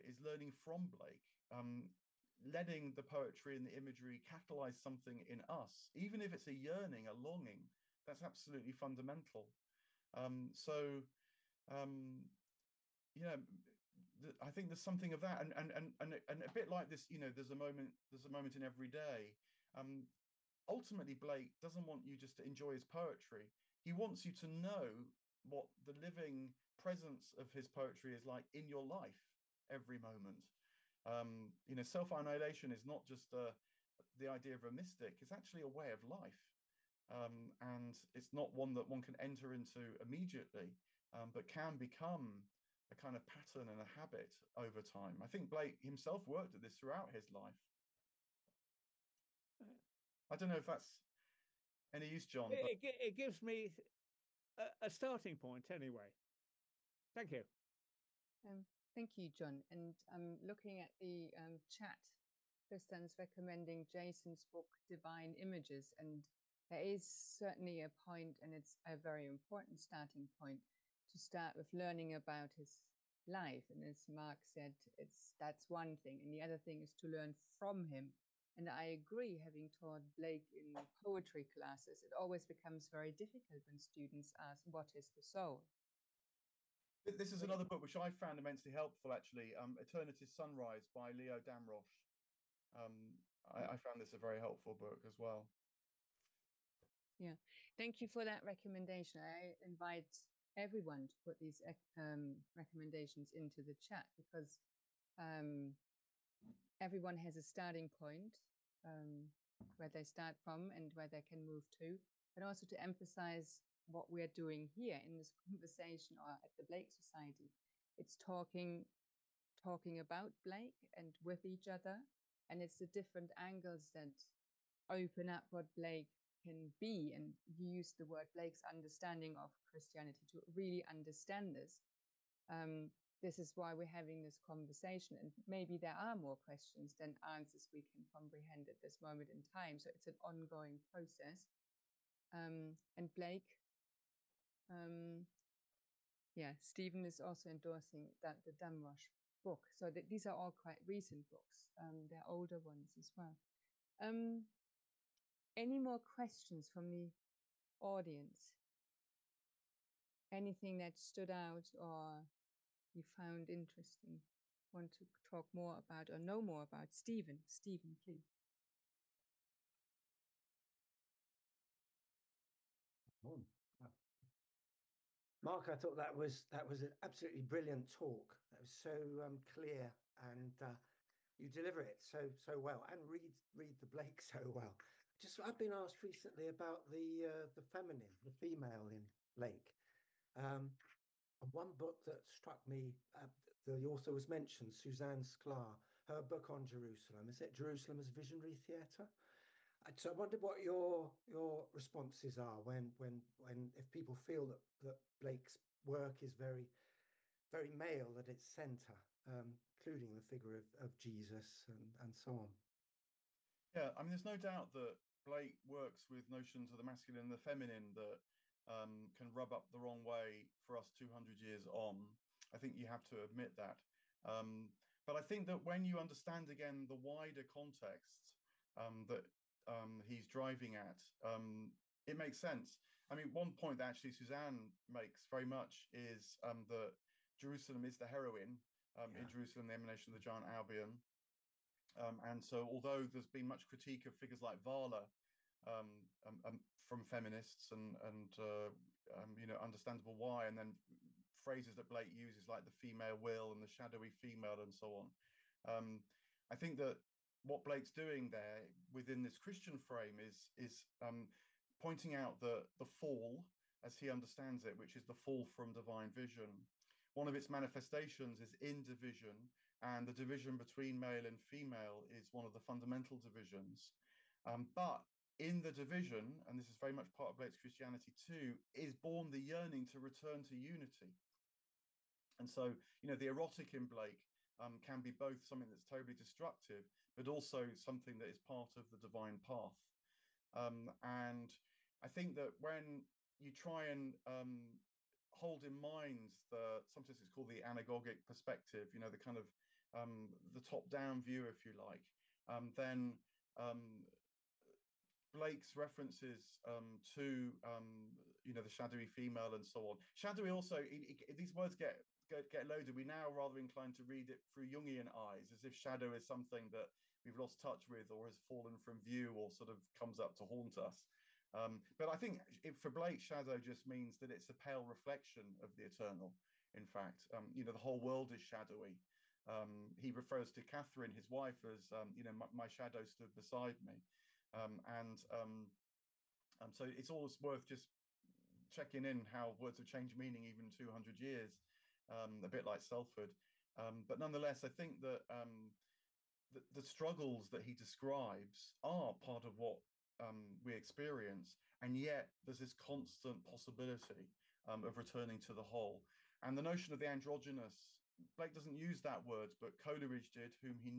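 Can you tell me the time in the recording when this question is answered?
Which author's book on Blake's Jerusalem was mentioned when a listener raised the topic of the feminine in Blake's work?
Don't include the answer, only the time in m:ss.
3:14.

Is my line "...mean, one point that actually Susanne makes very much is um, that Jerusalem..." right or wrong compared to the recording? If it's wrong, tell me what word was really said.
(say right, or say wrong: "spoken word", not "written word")
right.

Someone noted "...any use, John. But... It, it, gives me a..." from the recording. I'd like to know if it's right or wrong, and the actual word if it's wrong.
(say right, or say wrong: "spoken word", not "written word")
right.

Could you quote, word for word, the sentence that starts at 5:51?
And yet, there's this constant possibility um, of returning to the whole.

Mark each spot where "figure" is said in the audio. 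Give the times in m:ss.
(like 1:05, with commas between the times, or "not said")
3:30, 4:04.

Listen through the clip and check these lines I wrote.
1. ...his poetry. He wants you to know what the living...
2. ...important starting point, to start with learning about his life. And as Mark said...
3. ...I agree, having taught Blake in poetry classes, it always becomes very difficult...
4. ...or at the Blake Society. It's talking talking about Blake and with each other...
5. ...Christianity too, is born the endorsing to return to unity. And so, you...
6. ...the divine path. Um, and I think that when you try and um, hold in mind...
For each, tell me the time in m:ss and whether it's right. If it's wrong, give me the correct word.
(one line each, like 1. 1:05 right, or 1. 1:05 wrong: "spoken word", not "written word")
1. 0:22 right
2. 1:09 right
3. 1:18 right
4. 1:56 right
5. 4:37 wrong: "yearning", not "endorsing"
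6. 4:48 right.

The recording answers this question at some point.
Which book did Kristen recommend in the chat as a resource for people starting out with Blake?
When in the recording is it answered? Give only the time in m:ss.
1:04.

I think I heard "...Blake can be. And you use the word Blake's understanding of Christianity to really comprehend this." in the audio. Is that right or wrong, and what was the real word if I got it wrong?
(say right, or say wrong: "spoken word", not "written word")
wrong: "understand", not "comprehend".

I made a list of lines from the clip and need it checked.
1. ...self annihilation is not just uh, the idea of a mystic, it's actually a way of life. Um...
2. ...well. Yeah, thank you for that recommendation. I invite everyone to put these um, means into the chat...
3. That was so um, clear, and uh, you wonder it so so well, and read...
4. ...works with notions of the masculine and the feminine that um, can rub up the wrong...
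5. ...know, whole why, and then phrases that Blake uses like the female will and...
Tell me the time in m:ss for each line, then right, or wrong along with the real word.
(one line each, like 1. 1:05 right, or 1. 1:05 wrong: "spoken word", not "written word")
1. 0:31 right
2. 1:35 wrong: "recommendations", not "means"
3. 2:58 wrong: "deliver", not "wonder"
4. 3:35 right
5. 4:09 wrong: "understandable", not "whole".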